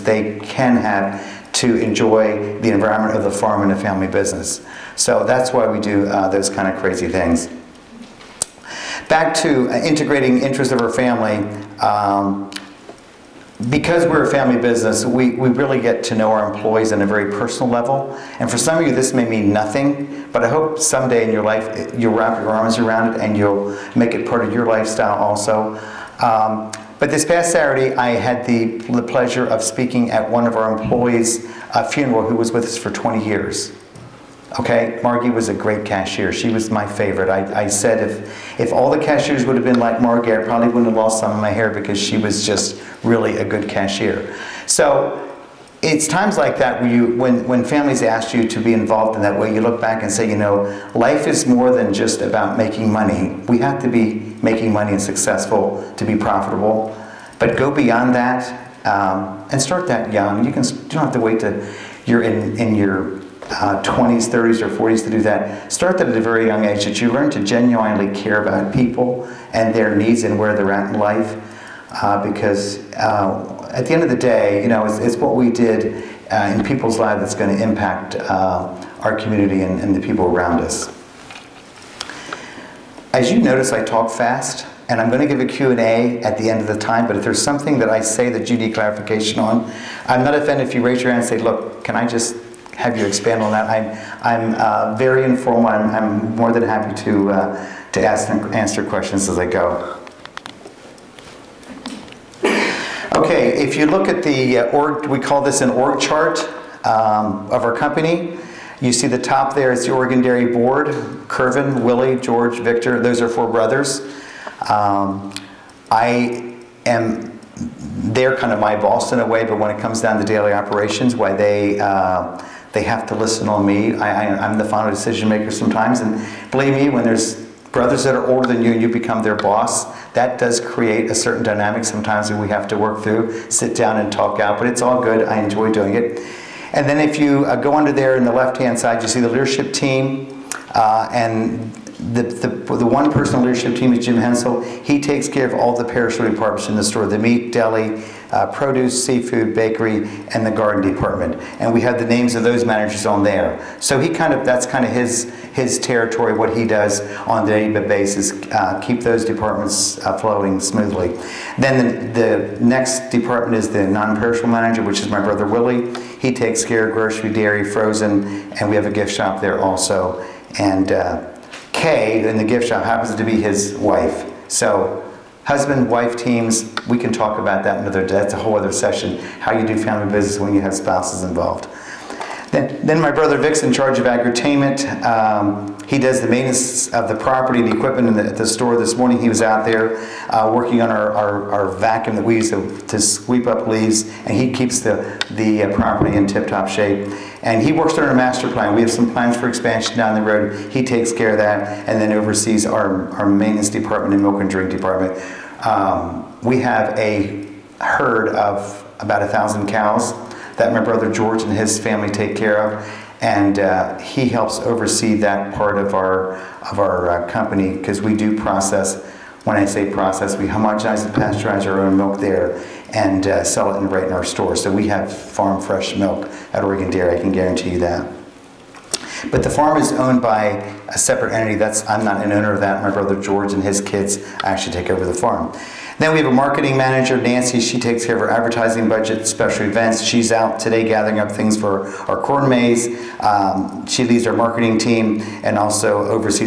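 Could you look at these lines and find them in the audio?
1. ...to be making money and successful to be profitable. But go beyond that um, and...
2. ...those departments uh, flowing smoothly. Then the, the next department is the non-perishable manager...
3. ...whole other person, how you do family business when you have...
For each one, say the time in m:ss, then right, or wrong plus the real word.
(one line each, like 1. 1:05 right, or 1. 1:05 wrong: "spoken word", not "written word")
1. 0:53 right
2. 2:39 right
3. 2:58 wrong: "session", not "person".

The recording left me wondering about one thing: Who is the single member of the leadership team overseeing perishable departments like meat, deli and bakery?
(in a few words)
Jim Hensel.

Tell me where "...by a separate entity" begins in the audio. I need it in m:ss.
3:50.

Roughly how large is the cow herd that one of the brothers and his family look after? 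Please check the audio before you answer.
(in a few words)
1000.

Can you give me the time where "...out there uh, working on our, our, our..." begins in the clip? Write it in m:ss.
3:09.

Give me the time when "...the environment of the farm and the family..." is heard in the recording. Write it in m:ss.
0:02.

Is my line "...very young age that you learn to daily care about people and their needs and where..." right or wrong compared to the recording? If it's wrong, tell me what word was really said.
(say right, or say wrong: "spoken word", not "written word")
wrong: "genuinely", not "daily".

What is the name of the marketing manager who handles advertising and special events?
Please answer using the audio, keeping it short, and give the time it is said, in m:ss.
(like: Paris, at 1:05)
Nancy, at 3:57.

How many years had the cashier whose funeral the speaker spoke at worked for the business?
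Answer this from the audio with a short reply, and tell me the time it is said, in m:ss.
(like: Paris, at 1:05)
20, at 0:32.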